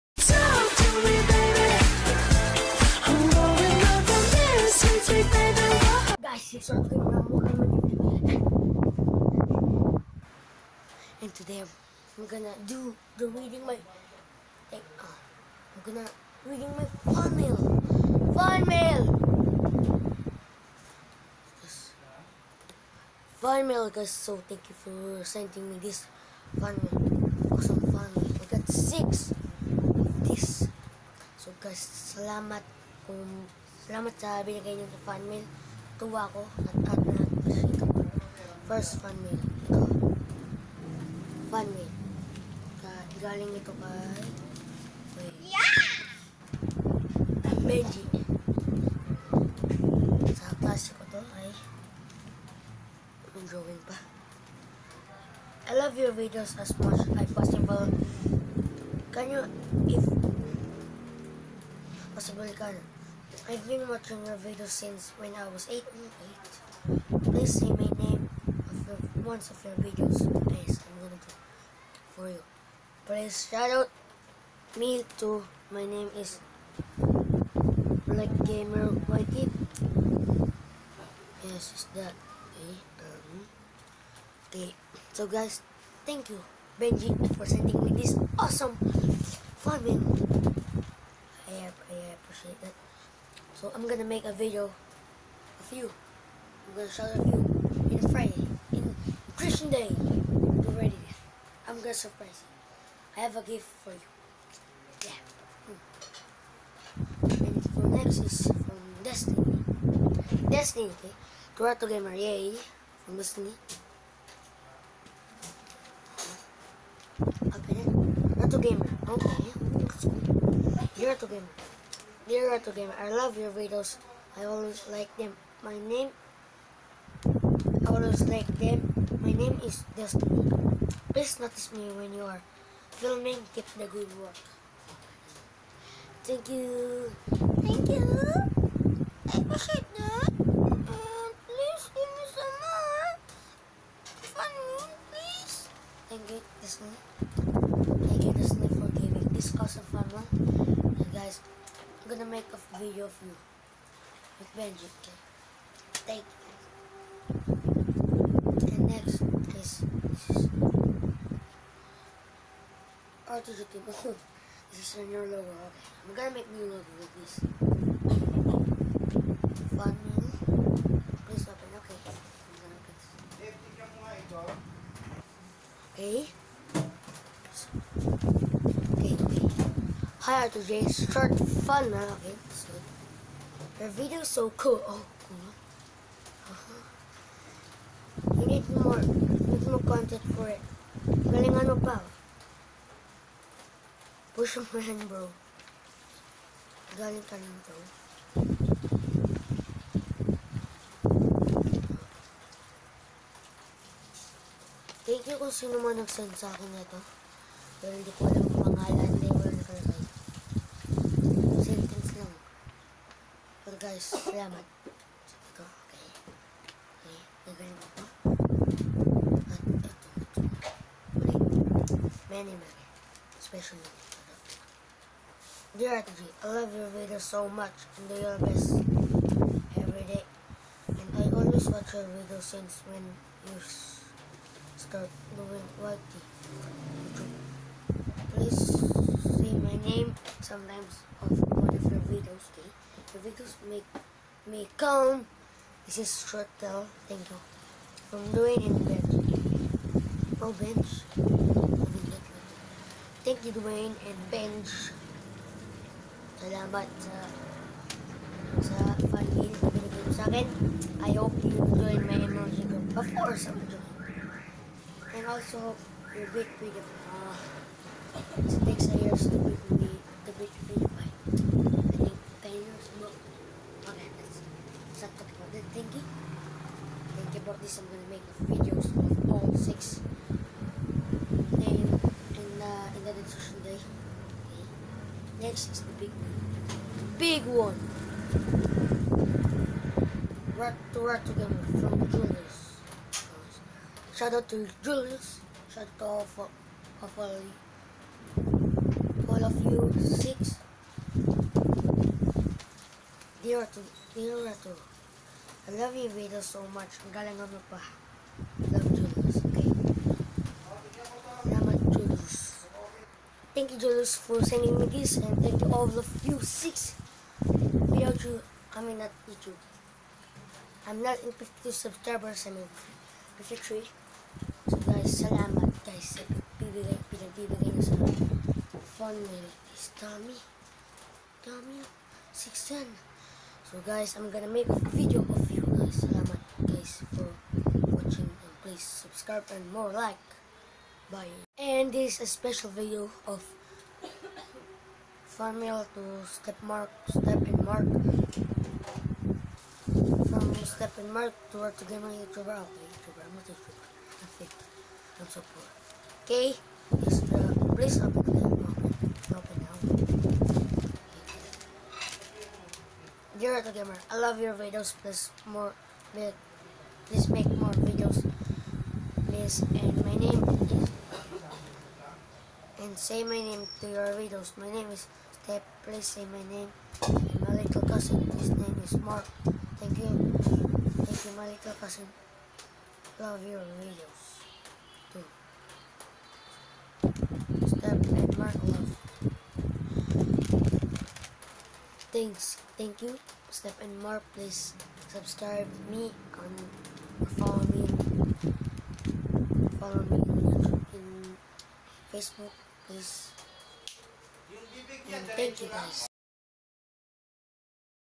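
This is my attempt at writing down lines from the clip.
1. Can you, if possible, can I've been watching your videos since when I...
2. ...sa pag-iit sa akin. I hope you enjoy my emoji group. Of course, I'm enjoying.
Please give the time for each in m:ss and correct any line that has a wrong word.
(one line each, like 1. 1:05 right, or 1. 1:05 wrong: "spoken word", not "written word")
1. 0:59 right
2. 4:18 right.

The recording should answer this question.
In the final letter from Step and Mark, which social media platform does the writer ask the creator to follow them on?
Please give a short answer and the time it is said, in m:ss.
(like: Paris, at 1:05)
Facebook, at 6:42.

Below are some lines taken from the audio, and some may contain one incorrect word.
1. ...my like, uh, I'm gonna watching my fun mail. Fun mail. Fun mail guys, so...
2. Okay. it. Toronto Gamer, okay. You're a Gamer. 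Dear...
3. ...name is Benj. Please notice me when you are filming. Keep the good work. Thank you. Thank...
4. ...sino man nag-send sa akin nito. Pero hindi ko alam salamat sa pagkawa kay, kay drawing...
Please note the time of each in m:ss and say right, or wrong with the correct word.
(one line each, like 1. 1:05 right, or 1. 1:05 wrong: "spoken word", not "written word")
1. 0:13 wrong: "reading", not "watching"
2. 1:57 right
3. 2:09 wrong: "Destiny", not "Benj"
4. 3:25 wrong: "nagaling", not "drawing".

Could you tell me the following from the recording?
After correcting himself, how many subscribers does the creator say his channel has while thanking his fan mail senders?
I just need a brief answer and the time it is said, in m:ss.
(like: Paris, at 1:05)
53, at 5:23.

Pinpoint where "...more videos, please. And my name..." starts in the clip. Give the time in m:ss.
6:07.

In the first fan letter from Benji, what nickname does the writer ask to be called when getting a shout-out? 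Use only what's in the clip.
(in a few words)
Black Gamer Whitey.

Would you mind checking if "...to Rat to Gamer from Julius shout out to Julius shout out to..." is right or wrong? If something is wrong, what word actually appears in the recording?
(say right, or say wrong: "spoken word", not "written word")
right.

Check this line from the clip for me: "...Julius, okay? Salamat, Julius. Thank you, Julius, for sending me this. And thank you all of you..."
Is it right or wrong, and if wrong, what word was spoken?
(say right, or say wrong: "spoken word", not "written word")
right.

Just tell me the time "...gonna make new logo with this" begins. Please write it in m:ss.
2:46.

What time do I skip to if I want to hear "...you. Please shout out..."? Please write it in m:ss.
1:12.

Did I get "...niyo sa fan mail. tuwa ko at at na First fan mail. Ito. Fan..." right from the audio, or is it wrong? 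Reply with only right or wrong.
right.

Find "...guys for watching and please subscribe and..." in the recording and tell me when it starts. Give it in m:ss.
5:36.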